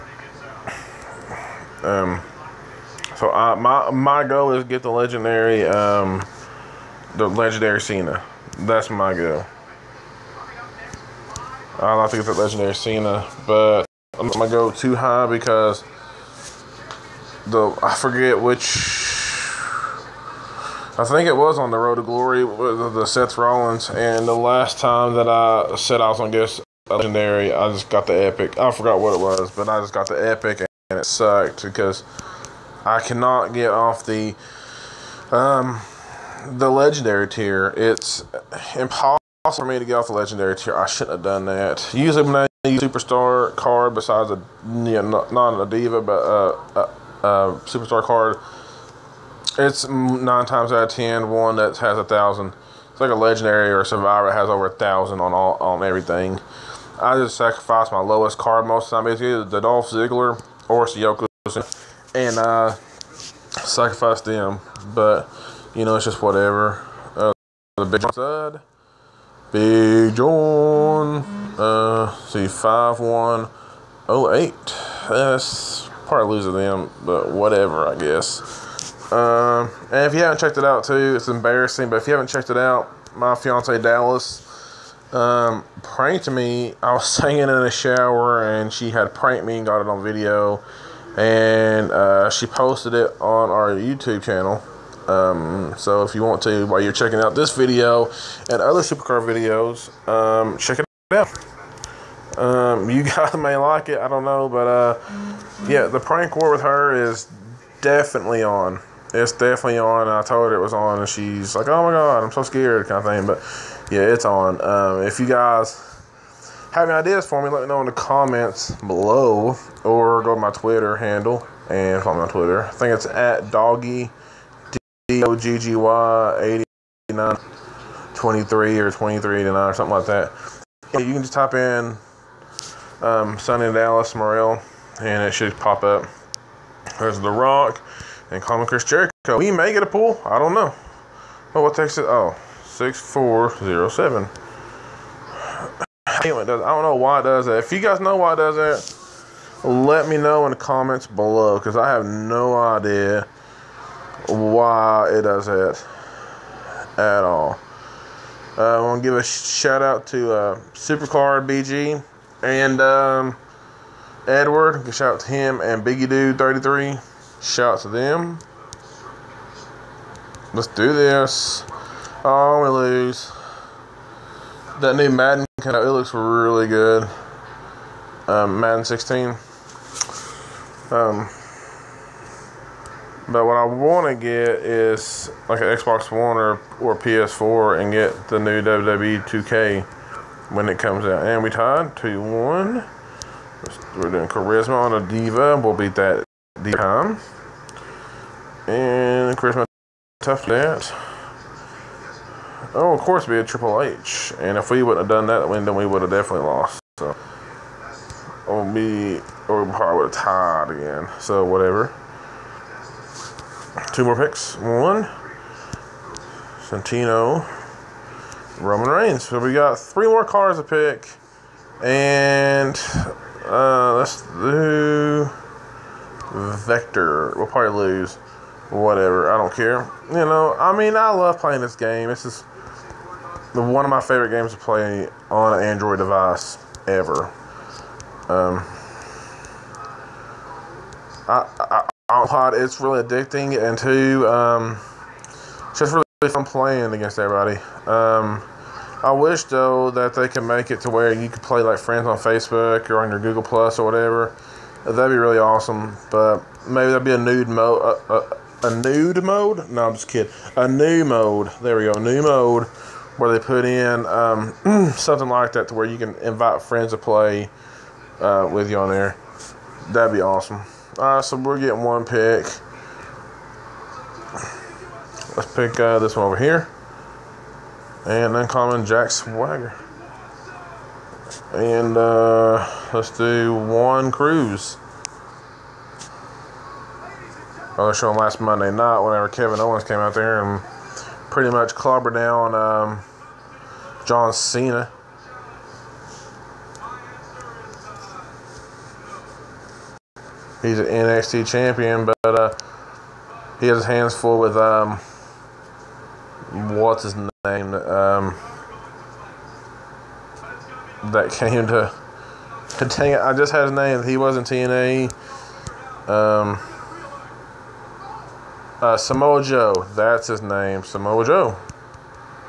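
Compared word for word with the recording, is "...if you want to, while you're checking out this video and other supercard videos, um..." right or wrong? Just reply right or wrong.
right.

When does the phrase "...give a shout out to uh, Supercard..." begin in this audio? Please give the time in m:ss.
2:39.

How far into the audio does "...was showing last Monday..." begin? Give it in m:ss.
4:47.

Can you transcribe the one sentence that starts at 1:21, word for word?
But if you haven't checked it out, my fiance Dallas um, pranked me.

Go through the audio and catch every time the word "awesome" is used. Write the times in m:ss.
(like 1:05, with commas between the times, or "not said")
4:15, 4:30.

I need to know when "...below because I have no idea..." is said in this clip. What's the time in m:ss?
2:31.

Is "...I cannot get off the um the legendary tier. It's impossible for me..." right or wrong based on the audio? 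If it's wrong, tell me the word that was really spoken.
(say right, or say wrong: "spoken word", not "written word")
right.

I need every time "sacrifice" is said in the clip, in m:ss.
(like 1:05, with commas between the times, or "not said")
0:57, 1:03.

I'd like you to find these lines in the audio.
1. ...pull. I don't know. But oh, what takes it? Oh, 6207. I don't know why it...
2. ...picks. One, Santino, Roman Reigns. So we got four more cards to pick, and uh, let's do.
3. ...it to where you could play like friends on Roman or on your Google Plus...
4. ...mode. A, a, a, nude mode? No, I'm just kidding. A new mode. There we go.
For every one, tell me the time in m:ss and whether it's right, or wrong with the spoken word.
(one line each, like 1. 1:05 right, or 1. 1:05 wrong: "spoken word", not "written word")
1. 2:19 wrong: "6407", not "6207"
2. 3:34 wrong: "three", not "four"
3. 4:10 wrong: "Facebook", not "Roman"
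4. 4:17 right.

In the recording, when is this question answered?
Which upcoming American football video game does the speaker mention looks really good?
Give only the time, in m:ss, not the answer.
2:58.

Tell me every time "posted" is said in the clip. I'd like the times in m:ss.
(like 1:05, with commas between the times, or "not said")
1:32.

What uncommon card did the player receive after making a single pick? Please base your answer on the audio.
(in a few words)
Jack Swagger.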